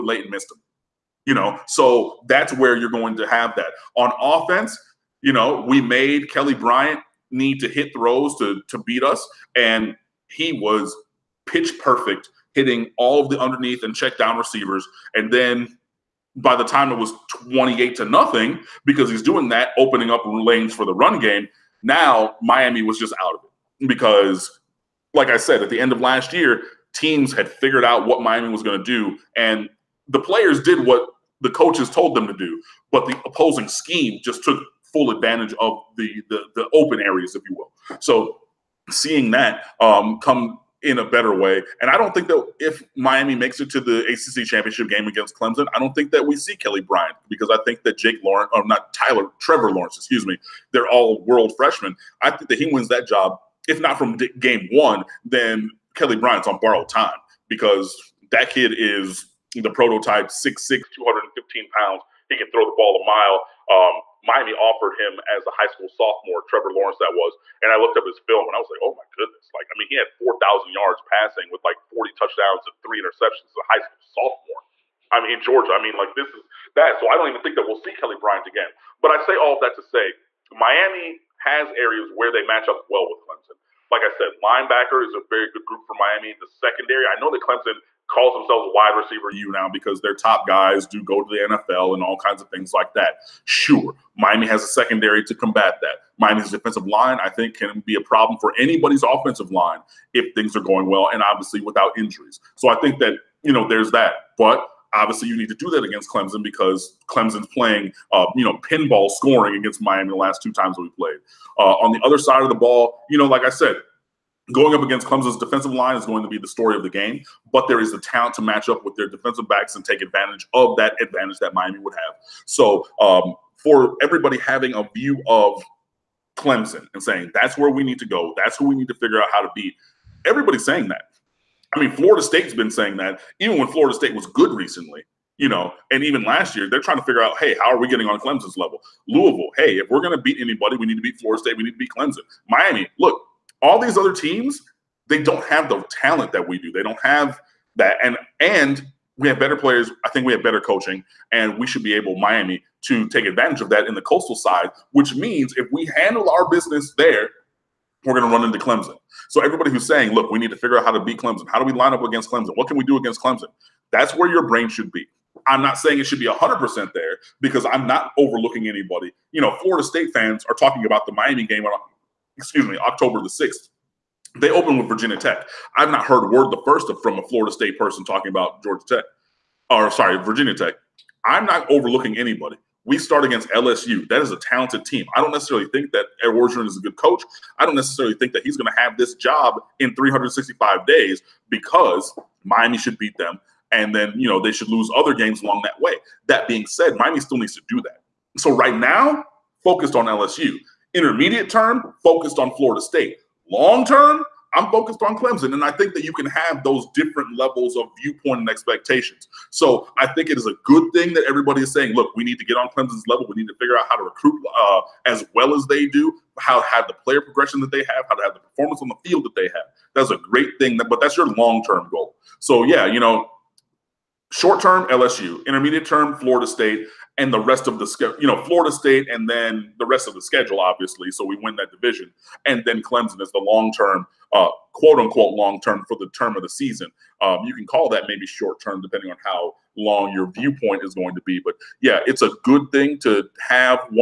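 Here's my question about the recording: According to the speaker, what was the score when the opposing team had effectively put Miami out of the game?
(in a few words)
28 to 0.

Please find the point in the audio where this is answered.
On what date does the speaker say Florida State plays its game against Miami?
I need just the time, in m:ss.
2:52.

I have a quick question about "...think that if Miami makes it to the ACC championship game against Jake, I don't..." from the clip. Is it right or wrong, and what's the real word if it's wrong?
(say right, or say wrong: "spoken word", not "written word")
wrong: "Clemson", not "Jake".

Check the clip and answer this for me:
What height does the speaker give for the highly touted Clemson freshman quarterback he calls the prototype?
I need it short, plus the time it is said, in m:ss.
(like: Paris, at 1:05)
6'6, at 1:00.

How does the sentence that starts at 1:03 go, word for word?
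Um, Miami offered him as a high school sophomore, Trevor Lawrence, that was.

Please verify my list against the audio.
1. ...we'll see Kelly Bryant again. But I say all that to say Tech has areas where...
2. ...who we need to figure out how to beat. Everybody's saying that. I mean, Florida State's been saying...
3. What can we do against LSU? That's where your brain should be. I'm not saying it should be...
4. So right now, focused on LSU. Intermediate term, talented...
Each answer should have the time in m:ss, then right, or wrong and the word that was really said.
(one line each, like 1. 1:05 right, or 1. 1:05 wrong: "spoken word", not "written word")
1. 1:17 wrong: "Miami", not "Tech"
2. 2:08 right
3. 2:42 wrong: "Clemson", not "LSU"
4. 3:18 wrong: "focused", not "talented".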